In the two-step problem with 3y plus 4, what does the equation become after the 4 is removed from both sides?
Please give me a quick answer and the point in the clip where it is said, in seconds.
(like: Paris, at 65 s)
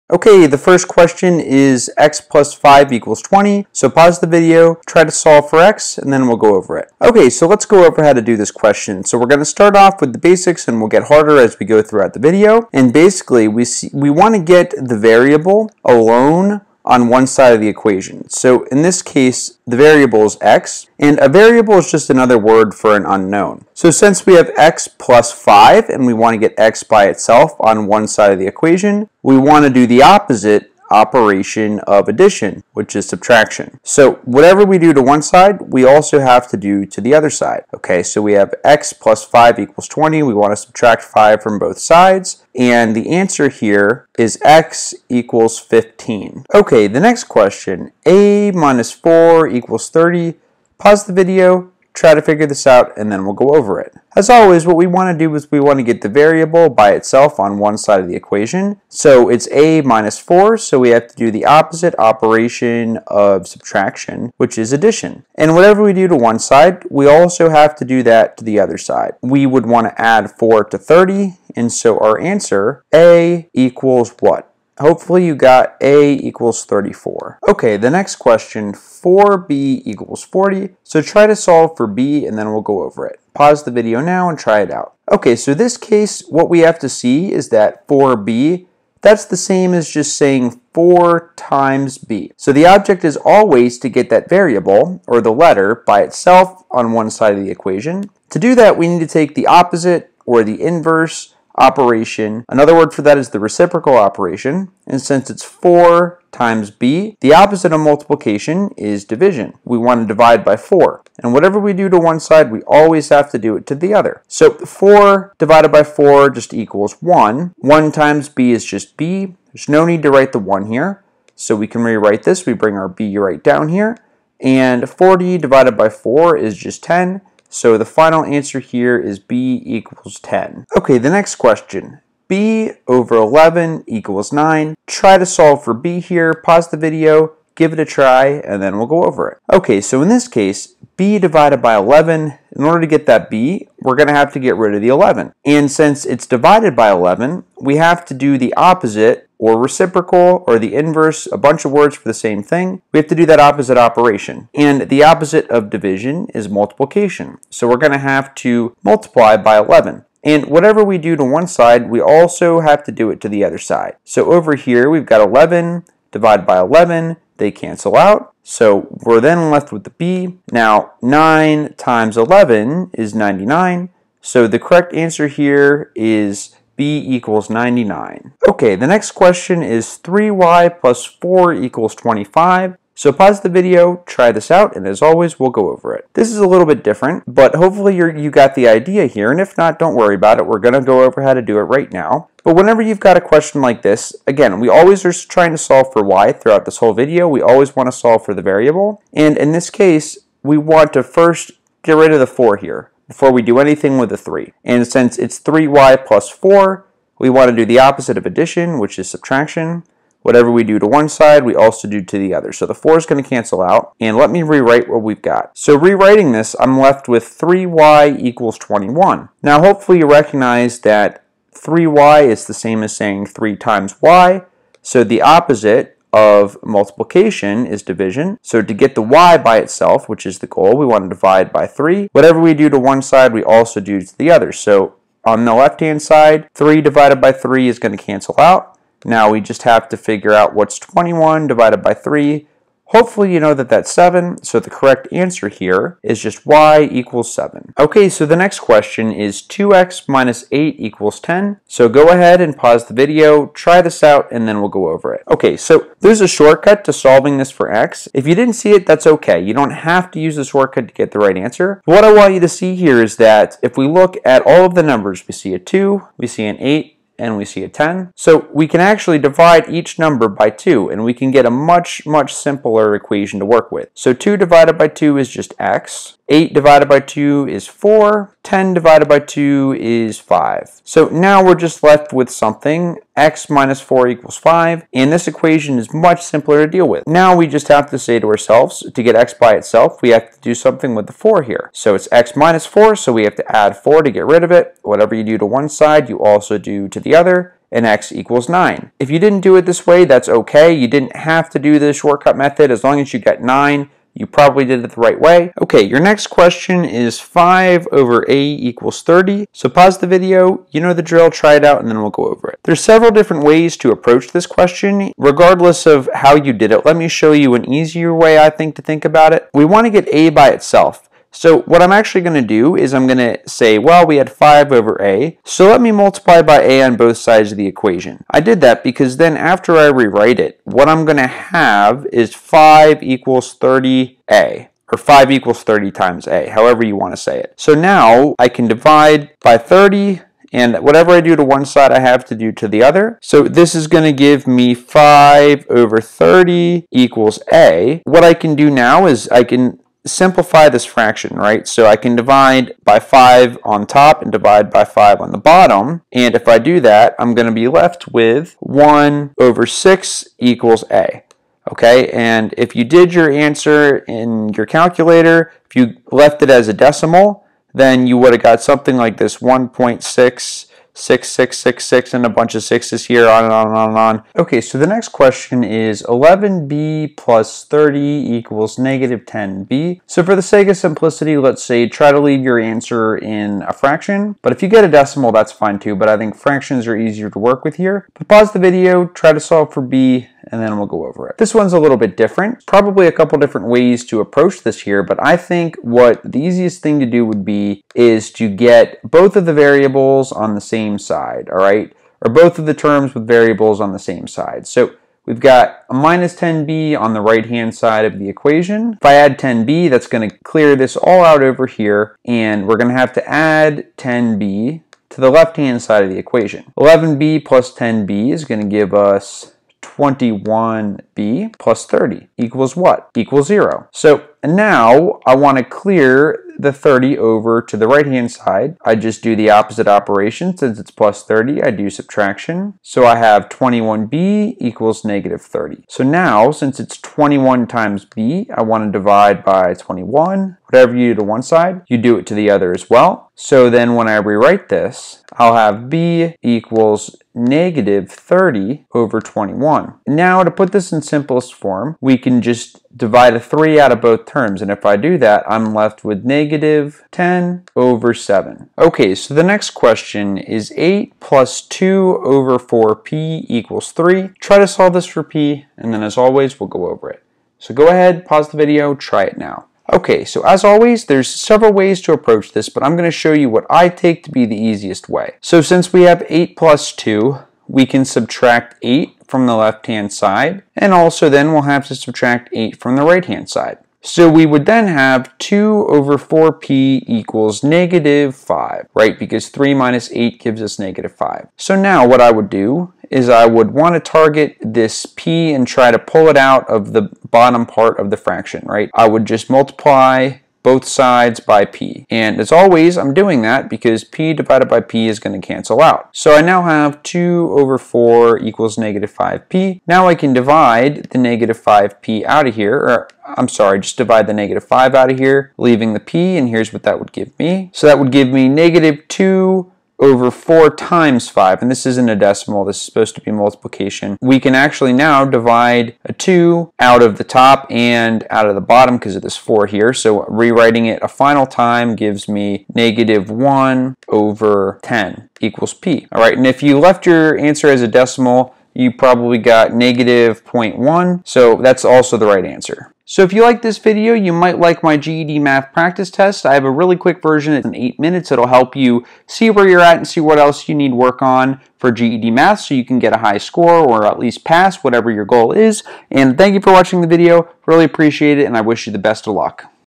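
3y = 21, at 217 s.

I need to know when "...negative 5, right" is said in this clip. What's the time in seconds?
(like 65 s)
487 s.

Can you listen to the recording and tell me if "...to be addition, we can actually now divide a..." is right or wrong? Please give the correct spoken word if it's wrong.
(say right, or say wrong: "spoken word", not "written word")
wrong: "multiplication", not "addition".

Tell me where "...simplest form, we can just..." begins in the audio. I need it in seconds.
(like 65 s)
451 s.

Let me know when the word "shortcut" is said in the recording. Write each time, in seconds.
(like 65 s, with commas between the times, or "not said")
256 s, 260 s, 301 s.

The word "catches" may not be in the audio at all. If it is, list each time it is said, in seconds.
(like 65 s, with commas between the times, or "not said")
not said.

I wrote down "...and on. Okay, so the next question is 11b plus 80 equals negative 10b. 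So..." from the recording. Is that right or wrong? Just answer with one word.
wrong.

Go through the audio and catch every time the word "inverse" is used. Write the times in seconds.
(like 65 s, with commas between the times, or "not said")
100 s, 150 s.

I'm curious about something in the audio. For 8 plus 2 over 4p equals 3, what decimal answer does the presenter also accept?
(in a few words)
-0.1.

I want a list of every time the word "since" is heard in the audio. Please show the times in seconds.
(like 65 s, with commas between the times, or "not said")
23 s, 105 s, 145 s, 204 s, 430 s, 436 s, 475 s.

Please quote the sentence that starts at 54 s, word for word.
As always, what we want to do is we want to get the variable by itself on one side of the equation.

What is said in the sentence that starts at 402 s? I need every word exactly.
Or both of the terms with variables on the same side.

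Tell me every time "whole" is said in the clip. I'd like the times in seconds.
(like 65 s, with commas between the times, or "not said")
196 s.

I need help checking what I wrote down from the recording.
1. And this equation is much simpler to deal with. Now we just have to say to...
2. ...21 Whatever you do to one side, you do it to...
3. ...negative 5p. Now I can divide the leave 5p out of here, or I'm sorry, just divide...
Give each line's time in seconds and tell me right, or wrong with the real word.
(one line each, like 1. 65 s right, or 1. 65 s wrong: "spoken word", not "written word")
1. 284 s right
2. 439 s right
3. 508 s wrong: "negative", not "leave".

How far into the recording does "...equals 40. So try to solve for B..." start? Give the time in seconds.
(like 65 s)
79 s.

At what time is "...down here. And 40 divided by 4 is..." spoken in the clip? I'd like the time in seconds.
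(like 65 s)
123 s.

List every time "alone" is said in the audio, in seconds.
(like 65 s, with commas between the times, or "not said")
15 s.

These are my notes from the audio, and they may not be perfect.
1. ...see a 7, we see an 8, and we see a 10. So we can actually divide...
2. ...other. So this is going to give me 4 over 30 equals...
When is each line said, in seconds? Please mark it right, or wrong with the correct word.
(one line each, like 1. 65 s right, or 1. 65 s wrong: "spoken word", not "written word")
1. 265 s wrong: "2", not "7"
2. 342 s wrong: "5", not "4".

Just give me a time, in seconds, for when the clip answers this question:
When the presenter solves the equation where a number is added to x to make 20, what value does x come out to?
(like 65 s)
44 s.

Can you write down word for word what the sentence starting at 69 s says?
We would want to add 4 to 30, and so our answer, a equals what?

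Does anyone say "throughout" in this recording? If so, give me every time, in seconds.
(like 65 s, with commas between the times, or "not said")
11 s, 196 s.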